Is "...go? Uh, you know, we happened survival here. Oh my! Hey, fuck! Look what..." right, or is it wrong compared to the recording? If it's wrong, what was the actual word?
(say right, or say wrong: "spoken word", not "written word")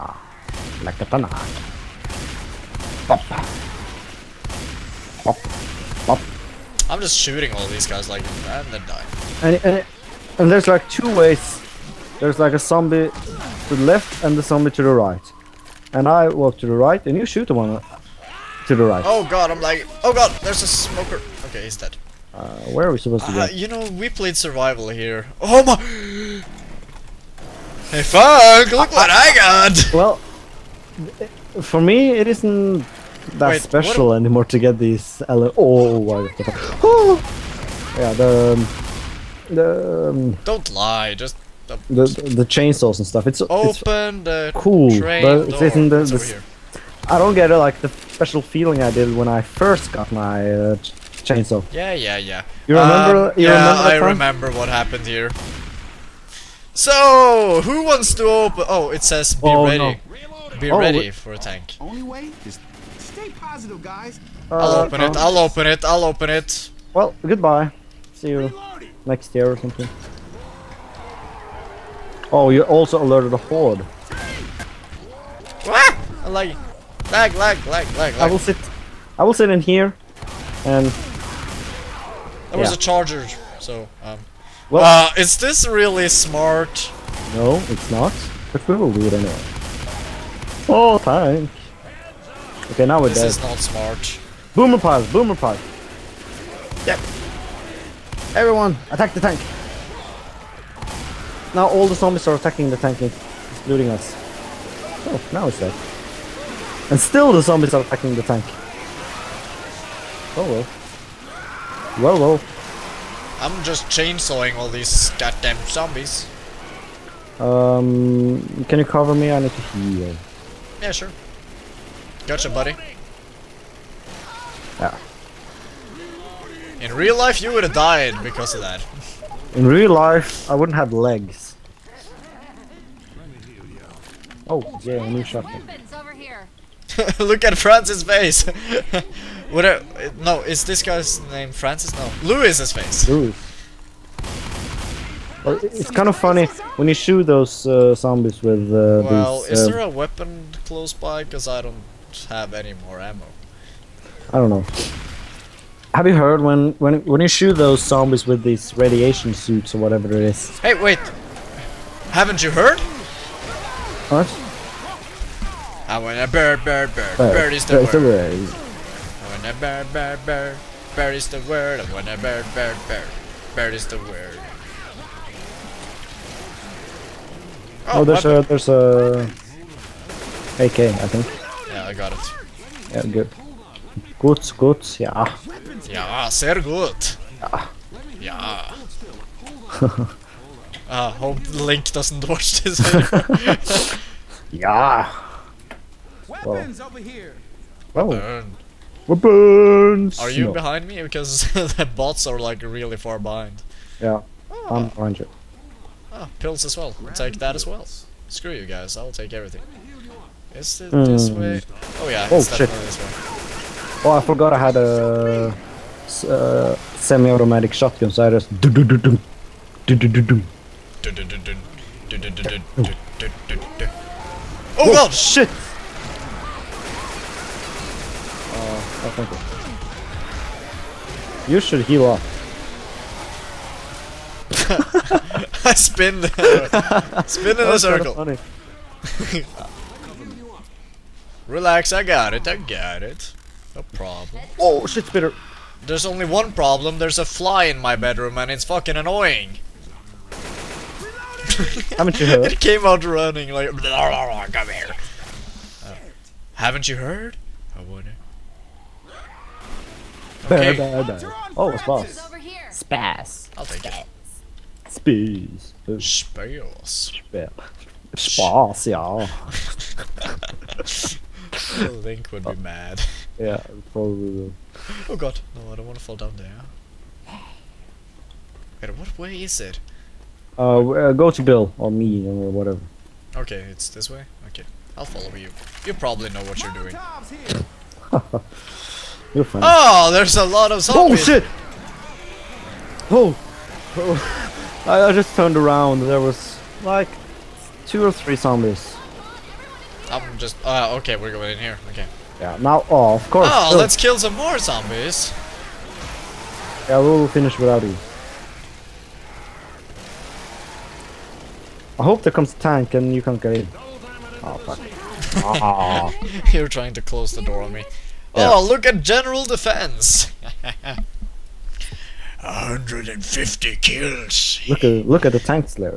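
wrong: "played", not "happened".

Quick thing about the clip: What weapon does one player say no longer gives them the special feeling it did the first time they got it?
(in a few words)
chainsaw.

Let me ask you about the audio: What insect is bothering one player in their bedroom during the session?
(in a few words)
fly.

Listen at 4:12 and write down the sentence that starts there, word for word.
it came out running like, blah, blah, blah, come here.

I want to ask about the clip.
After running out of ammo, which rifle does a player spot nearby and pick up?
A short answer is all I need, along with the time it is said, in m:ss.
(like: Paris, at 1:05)
AK, at 3:00.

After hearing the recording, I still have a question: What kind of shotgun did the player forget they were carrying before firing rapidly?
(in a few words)
semi-automatic shotgun.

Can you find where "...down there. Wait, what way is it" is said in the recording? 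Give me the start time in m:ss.
4:36.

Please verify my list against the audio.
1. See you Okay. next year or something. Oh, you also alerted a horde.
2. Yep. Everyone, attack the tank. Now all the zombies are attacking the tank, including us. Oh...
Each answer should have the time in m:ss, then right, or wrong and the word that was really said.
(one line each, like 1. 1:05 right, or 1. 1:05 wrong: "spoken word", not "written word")
1. 1:08 wrong: "Reloading", not "Okay"
2. 1:36 right.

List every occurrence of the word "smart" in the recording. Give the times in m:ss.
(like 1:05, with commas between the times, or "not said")
1:26, 1:33.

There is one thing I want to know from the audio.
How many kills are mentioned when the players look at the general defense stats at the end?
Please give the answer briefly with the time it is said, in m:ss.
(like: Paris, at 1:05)
150, at 5:22.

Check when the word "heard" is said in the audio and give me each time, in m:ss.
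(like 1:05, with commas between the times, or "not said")
2:36, 2:42, 4:12, 4:16.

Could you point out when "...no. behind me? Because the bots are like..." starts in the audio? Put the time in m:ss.
3:20.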